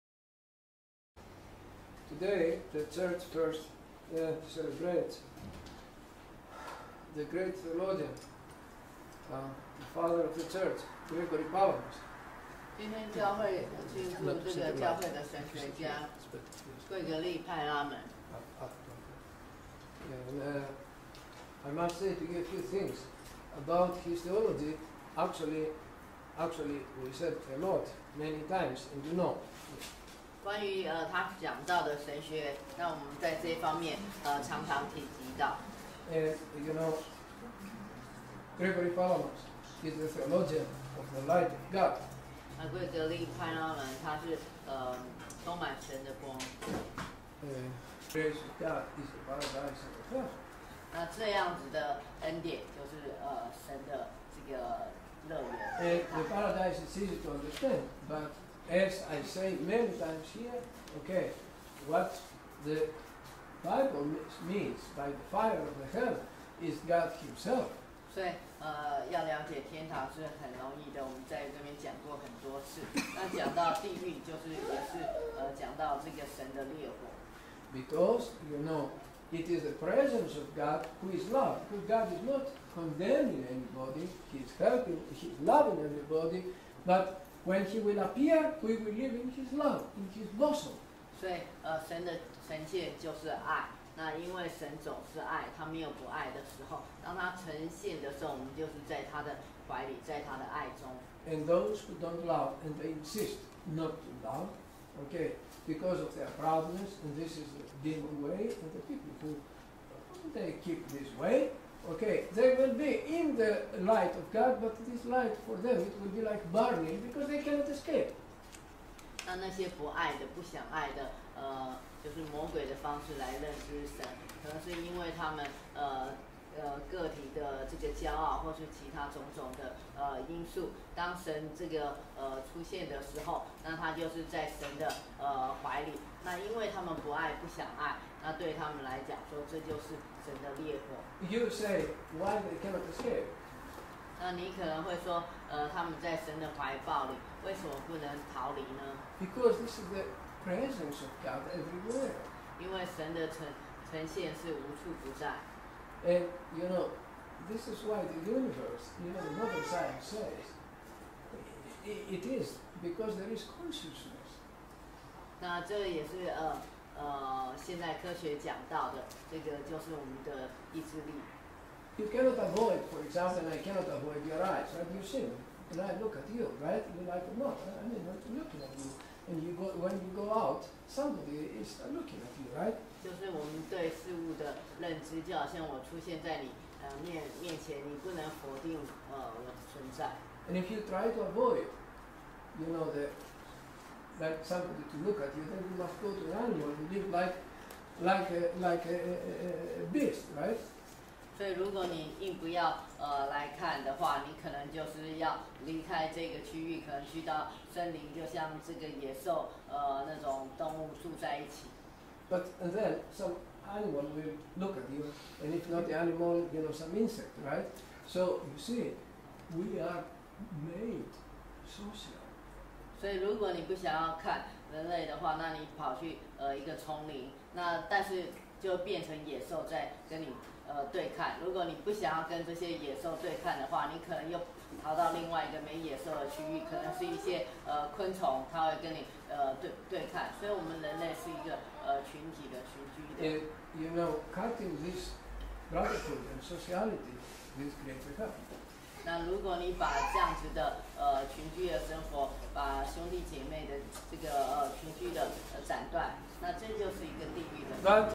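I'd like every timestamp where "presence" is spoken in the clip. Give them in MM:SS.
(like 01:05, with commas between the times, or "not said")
01:19, 02:30.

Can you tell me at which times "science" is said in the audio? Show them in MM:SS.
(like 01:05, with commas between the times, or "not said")
02:39.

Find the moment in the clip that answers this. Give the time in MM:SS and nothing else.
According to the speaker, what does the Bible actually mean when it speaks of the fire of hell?
01:06.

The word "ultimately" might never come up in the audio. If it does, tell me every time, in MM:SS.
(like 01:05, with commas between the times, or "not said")
not said.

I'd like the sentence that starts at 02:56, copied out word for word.
You like not, I mean, I'm looking at you.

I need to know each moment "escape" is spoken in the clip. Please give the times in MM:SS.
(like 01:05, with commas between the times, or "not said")
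01:57, 02:22.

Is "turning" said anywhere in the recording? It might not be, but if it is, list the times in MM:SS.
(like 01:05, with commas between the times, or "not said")
not said.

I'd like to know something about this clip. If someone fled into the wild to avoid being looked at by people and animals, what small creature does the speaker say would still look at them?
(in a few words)
insect.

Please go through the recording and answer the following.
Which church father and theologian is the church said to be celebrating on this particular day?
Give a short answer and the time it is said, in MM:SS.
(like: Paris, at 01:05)
Gregory Palamas, at 00:11.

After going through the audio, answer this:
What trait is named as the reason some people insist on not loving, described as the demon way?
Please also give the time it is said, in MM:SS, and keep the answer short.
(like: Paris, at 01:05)
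proudness, at 01:46.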